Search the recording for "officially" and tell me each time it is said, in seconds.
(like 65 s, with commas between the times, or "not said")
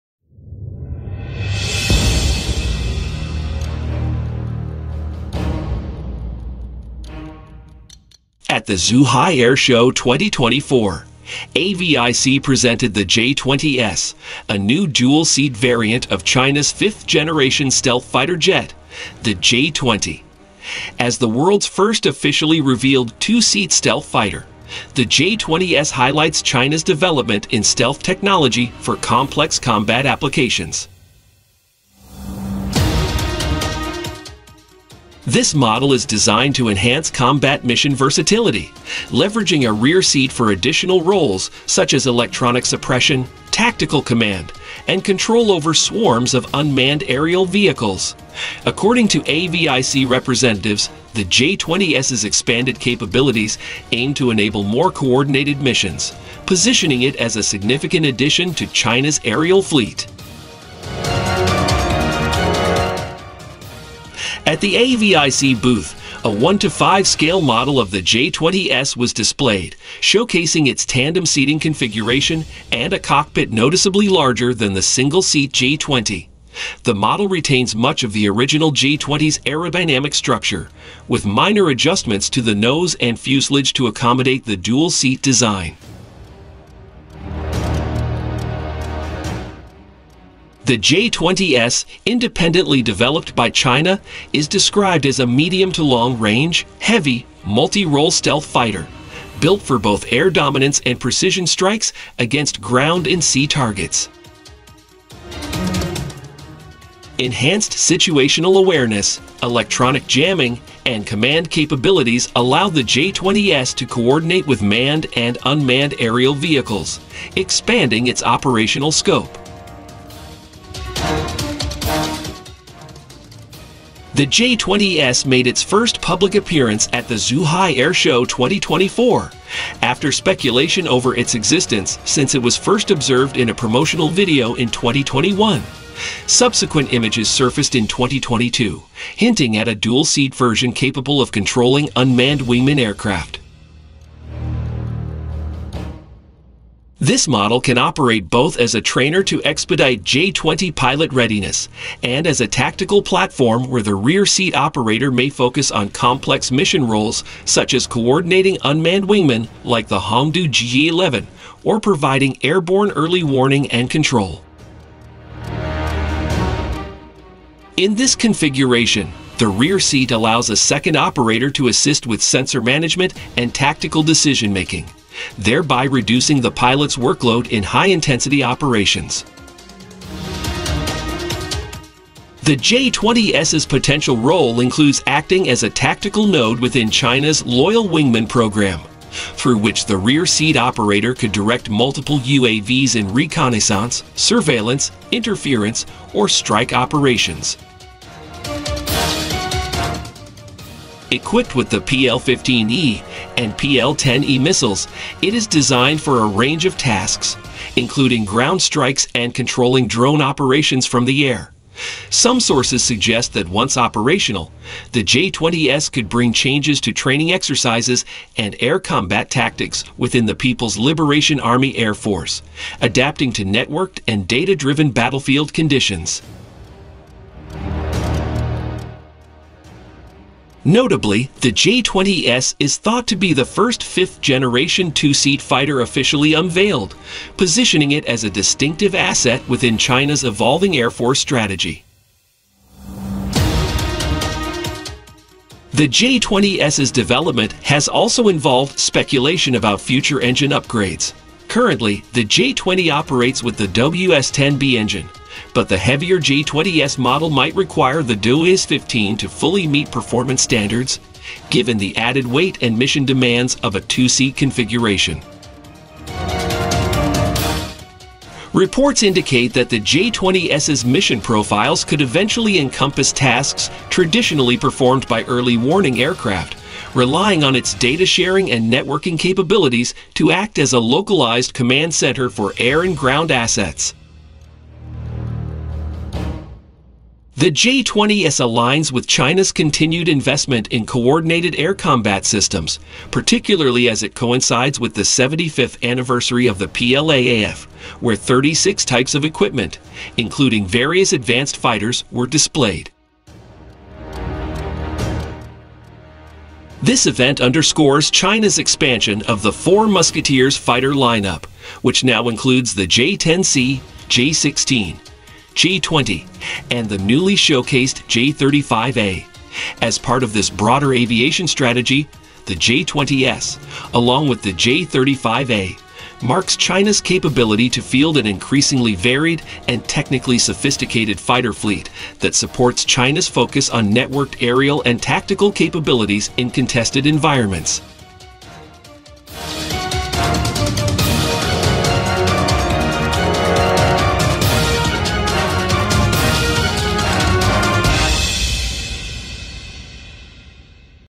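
22 s, 235 s.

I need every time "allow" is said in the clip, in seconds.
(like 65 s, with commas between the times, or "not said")
112 s, 170 s.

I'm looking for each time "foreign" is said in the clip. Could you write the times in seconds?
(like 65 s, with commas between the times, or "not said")
not said.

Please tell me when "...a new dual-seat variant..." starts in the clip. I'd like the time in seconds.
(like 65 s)
14 s.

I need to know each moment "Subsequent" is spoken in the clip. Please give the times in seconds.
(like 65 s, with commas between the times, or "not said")
136 s.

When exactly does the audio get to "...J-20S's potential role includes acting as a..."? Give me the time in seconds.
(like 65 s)
182 s.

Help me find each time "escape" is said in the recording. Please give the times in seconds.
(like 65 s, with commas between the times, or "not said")
not said.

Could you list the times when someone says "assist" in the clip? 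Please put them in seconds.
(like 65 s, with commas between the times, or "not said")
171 s.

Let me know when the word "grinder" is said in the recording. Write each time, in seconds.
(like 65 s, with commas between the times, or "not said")
not said.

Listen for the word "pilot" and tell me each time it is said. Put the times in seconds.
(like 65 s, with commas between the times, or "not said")
150 s, 176 s.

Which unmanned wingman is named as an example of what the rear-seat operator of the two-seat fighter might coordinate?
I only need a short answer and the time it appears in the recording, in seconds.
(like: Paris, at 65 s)
Hongdu G-11, at 159 s.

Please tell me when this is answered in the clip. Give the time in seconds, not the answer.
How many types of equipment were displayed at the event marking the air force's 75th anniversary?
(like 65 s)
298 s.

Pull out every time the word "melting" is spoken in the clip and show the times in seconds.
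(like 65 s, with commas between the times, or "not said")
not said.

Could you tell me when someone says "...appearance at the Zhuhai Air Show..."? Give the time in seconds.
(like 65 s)
126 s.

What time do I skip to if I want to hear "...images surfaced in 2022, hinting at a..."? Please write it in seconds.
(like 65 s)
136 s.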